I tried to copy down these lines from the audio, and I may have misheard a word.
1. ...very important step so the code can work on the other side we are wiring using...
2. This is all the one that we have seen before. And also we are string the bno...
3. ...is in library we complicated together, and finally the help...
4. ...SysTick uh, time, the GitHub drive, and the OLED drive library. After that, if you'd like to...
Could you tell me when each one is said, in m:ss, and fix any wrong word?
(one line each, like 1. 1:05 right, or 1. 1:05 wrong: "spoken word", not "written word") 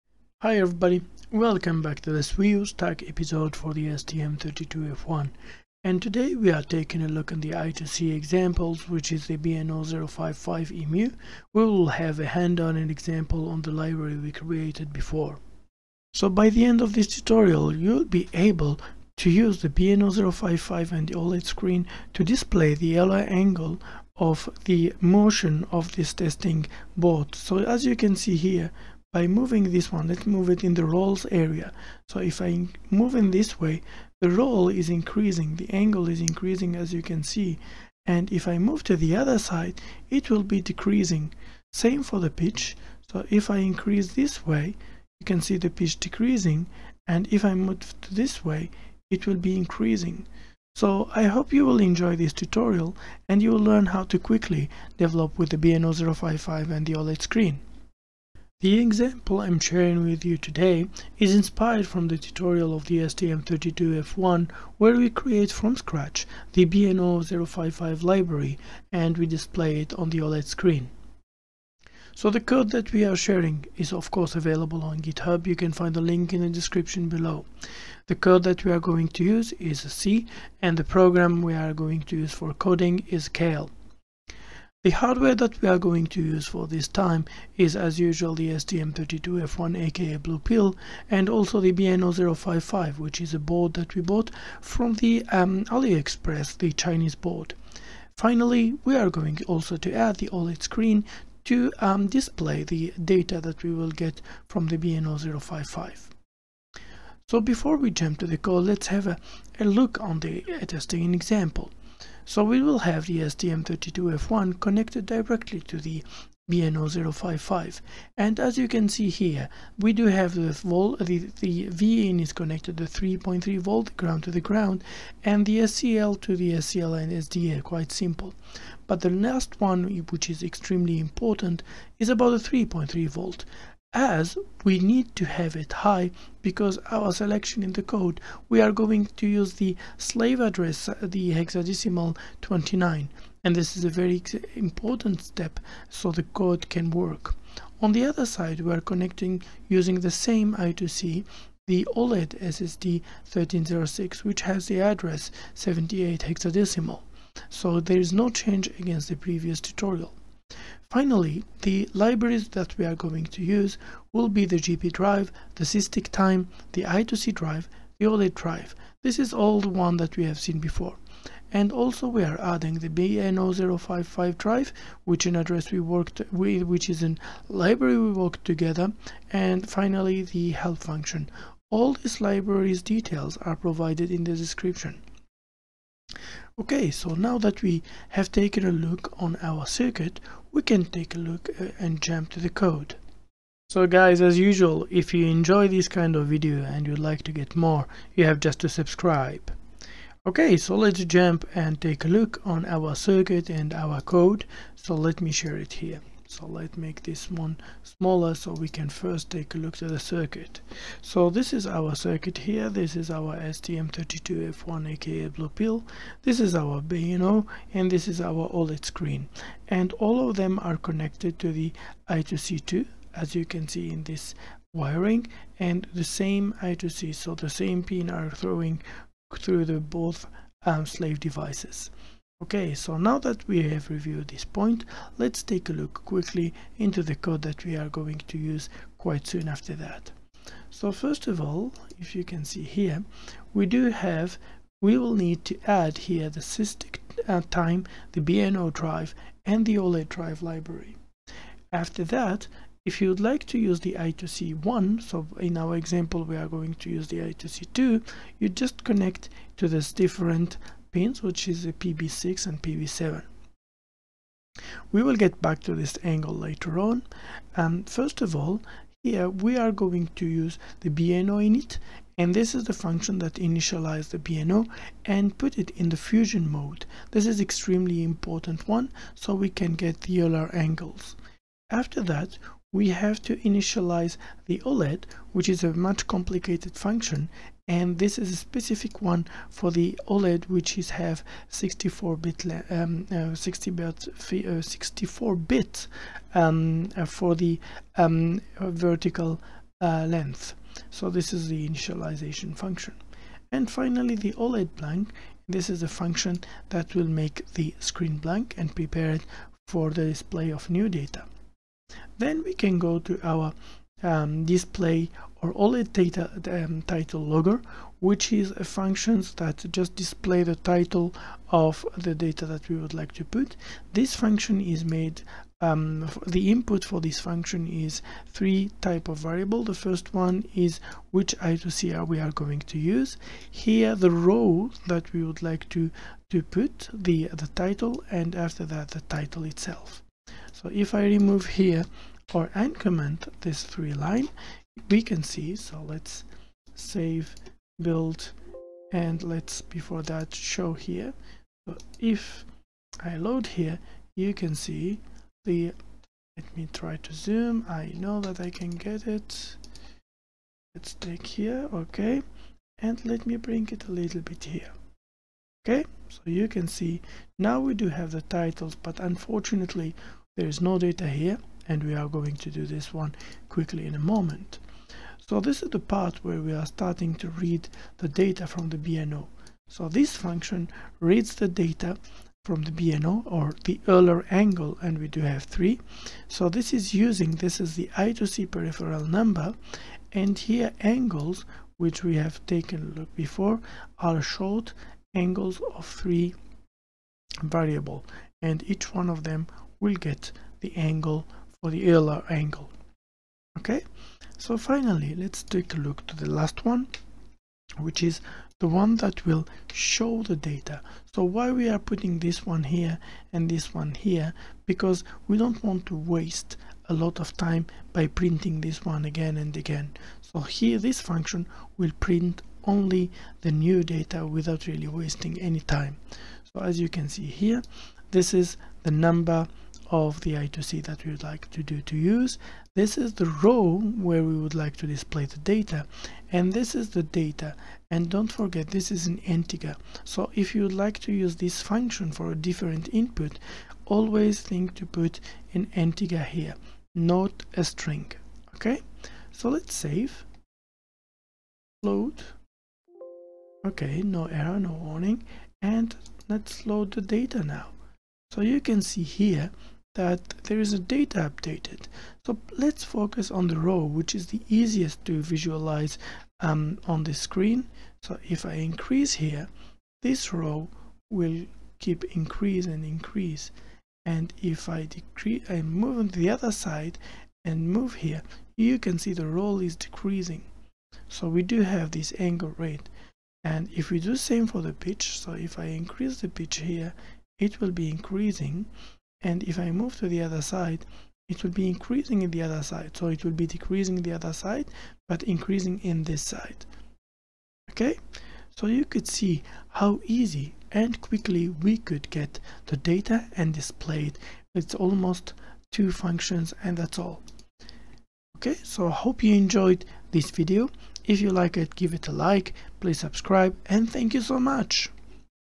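1. 2:23 wrong: "connecting", not "wiring"
2. 2:49 wrong: "adding", not "string"
3. 2:56 wrong: "worked", not "complicated"
4. 4:06 wrong: "BNO", not "GitHub".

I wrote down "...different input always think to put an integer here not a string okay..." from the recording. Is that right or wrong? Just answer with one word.
right.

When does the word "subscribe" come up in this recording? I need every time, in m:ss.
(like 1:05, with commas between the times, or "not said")
3:18, 8:32.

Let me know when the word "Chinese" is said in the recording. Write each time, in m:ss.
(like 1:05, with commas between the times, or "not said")
1:36.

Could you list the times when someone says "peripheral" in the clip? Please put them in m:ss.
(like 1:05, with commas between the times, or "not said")
6:28.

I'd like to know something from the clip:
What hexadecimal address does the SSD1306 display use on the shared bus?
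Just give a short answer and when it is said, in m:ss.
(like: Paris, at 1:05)
0x78, at 2:35.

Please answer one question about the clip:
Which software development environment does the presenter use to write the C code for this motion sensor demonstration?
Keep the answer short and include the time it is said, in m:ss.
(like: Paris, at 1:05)
Keil, at 1:23.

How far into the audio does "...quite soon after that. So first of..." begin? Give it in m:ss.
3:58.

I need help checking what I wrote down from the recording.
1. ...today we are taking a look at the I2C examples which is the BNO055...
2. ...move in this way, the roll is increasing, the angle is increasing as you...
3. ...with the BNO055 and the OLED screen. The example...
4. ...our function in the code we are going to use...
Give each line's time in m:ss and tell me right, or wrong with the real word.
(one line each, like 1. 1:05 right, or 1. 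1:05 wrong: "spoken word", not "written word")
1. 0:06 right
2. 0:32 right
3. 0:55 right
4. 2:16 wrong: "selection", not "function".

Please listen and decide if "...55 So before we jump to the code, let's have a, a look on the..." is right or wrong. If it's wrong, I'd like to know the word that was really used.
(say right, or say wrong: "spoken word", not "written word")
right.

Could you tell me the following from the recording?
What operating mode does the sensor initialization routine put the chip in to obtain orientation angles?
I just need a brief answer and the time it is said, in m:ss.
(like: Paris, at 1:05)
fusion mode, at 4:35.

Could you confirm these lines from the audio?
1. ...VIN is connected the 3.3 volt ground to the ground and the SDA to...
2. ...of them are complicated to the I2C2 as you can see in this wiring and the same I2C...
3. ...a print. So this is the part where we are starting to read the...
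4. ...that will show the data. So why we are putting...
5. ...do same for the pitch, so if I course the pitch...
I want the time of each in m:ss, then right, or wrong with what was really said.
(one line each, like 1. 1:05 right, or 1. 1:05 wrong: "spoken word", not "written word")
1. 2:01 wrong: "SCL", not "SDA"
2. 3:40 wrong: "connected", not "complicated"
3. 6:13 wrong: "moment", not "print"
4. 6:48 right
5. 8:03 wrong: "increase", not "course".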